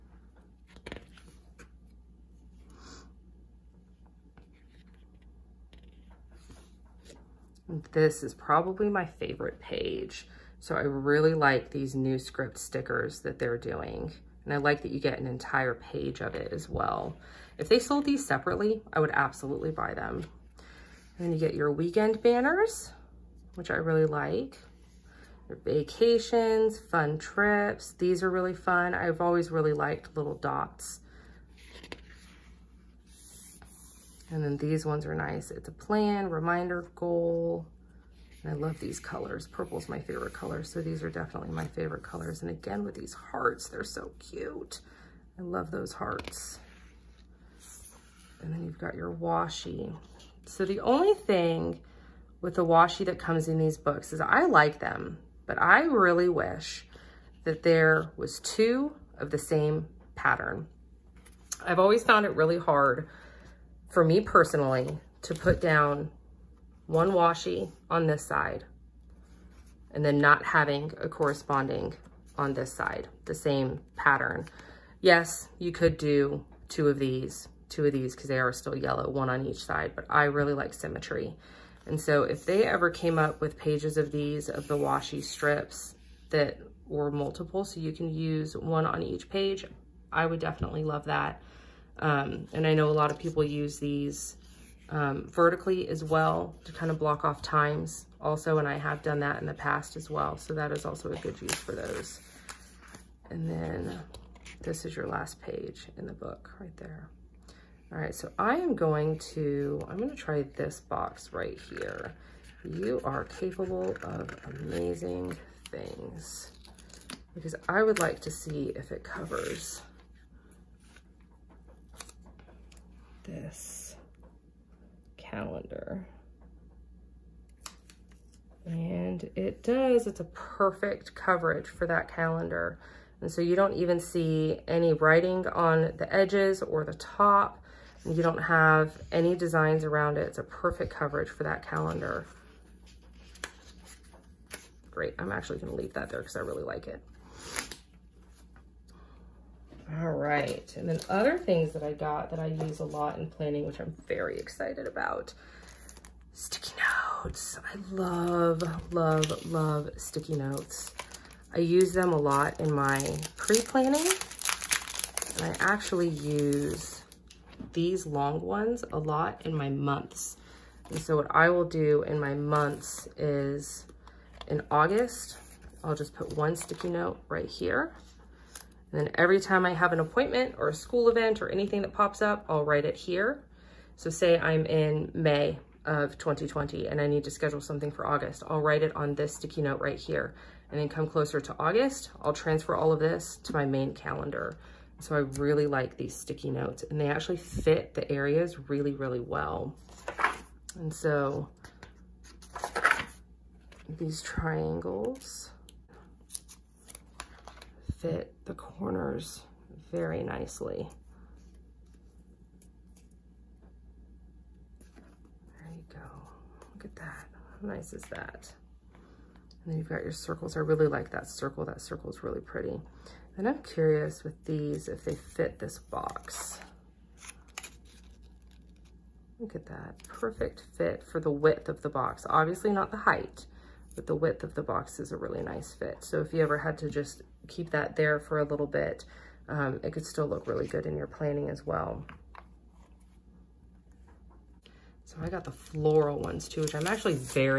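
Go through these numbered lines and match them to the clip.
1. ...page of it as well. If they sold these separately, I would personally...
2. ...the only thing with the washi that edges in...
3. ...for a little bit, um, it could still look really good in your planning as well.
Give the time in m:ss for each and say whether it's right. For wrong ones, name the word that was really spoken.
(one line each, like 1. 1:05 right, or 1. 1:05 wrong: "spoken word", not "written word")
1. 0:15 wrong: "absolutely", not "personally"
2. 0:50 wrong: "comes", not "edges"
3. 3:58 right.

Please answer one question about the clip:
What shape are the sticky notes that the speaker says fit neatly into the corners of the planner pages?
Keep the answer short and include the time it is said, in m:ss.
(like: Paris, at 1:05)
Triangles, at 3:24.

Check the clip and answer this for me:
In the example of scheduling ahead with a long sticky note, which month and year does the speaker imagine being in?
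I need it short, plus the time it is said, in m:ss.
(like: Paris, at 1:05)
May 2020, at 3:05.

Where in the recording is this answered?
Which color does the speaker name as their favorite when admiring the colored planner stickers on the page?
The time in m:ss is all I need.
0:39.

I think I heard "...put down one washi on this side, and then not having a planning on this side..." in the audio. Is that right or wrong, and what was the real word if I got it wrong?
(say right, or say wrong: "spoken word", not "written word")
wrong: "corresponding", not "planning".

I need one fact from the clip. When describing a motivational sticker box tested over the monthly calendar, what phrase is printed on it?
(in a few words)
You are capable of amazing things.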